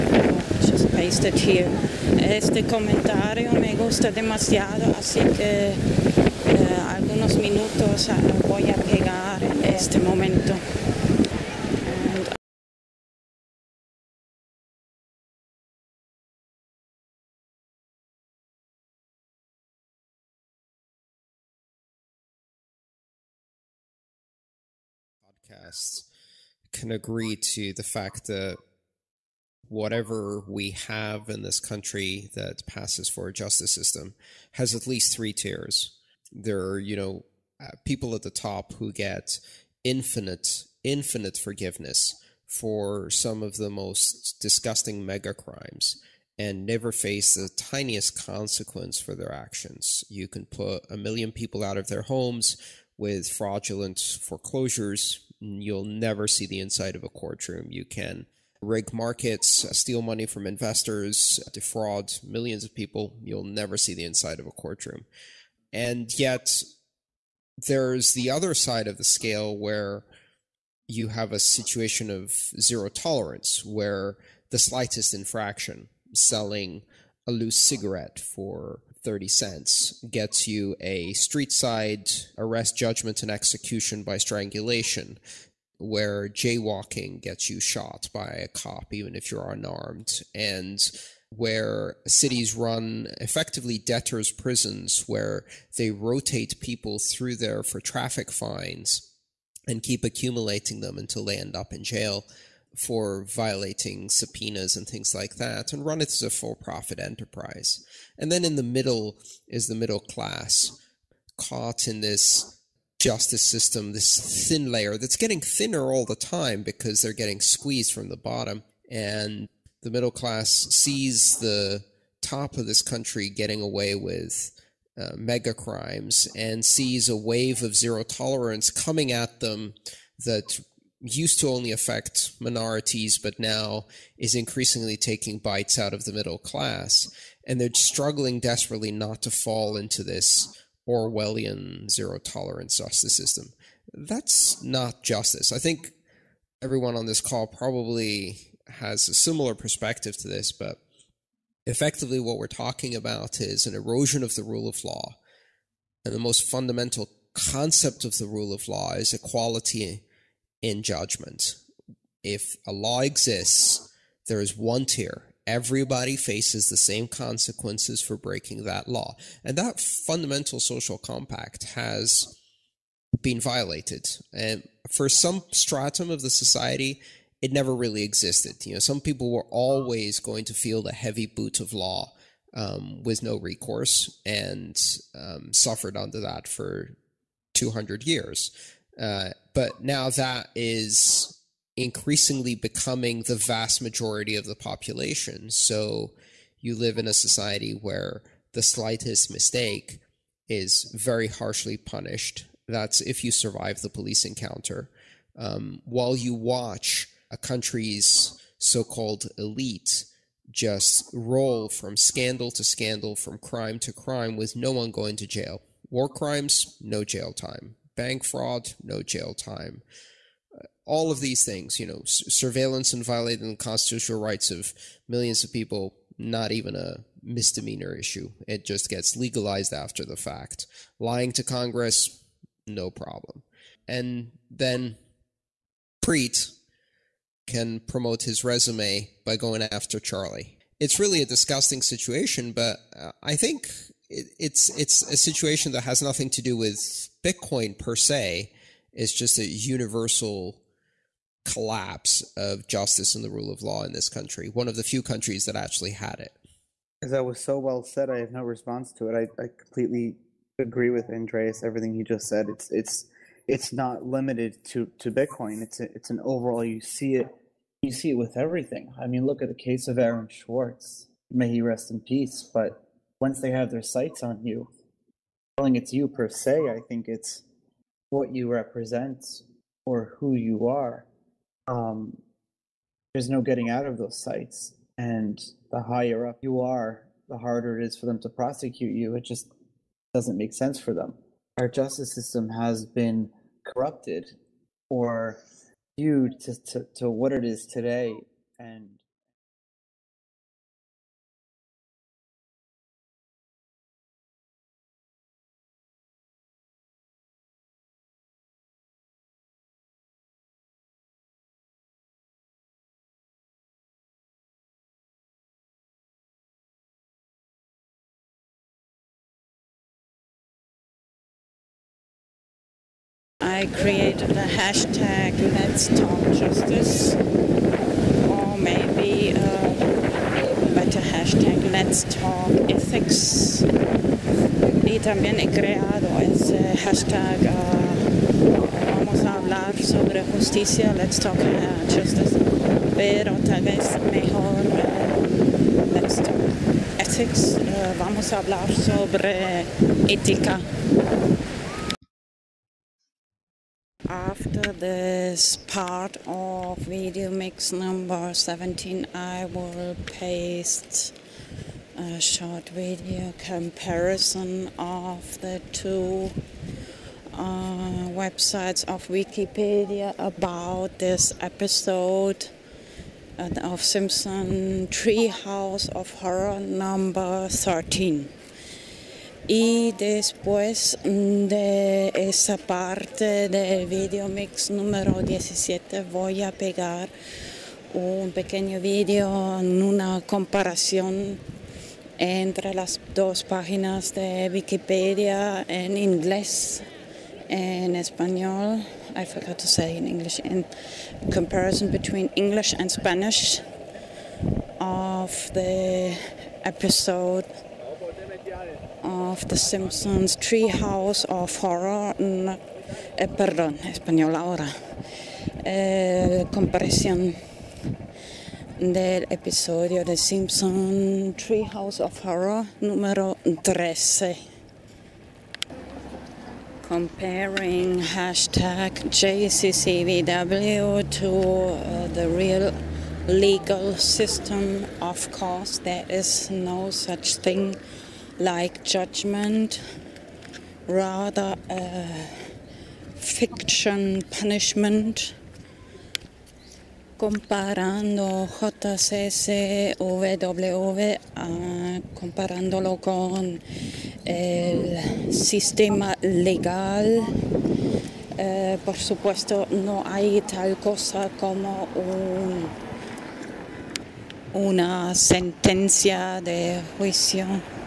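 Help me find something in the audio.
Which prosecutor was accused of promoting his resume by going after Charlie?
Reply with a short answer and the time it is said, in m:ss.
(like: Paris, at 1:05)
Preet, at 3:56.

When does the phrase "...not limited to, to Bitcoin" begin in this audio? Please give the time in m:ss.
4:23.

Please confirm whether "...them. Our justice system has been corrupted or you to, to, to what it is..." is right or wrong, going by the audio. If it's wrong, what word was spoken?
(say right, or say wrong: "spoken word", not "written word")
right.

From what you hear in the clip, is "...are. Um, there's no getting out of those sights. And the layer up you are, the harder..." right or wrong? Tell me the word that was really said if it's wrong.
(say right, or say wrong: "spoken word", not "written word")
wrong: "higher", not "layer".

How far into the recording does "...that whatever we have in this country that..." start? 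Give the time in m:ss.
0:28.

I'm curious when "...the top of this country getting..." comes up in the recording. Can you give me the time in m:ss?
2:01.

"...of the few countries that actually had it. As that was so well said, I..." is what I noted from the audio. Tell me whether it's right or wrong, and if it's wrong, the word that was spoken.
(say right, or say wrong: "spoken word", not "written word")
right.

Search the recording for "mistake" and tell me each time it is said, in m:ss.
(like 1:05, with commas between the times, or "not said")
3:19.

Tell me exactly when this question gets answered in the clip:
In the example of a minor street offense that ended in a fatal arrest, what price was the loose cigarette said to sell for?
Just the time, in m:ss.
1:19.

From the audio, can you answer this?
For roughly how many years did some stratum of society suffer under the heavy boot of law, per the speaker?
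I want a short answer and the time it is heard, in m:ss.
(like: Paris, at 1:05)
200 years, at 3:07.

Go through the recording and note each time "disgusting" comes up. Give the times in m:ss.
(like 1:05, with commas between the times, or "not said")
0:44, 4:01.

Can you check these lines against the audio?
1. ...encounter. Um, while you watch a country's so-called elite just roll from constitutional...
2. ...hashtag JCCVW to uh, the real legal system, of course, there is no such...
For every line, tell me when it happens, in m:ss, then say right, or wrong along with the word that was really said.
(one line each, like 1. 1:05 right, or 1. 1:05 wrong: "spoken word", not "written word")
1. 3:24 wrong: "scandal", not "constitutional"
2. 7:08 right.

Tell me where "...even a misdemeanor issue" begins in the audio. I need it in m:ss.
3:46.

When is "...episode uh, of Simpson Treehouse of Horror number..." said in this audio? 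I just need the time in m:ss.
6:11.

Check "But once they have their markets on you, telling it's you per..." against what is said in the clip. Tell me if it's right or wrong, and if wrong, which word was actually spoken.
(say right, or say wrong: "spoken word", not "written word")
wrong: "sights", not "markets".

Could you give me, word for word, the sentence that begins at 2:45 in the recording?
Everybody faces the same consequences for breaking that law.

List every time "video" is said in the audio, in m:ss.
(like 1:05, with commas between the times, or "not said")
5:56, 6:02, 6:23, 6:28.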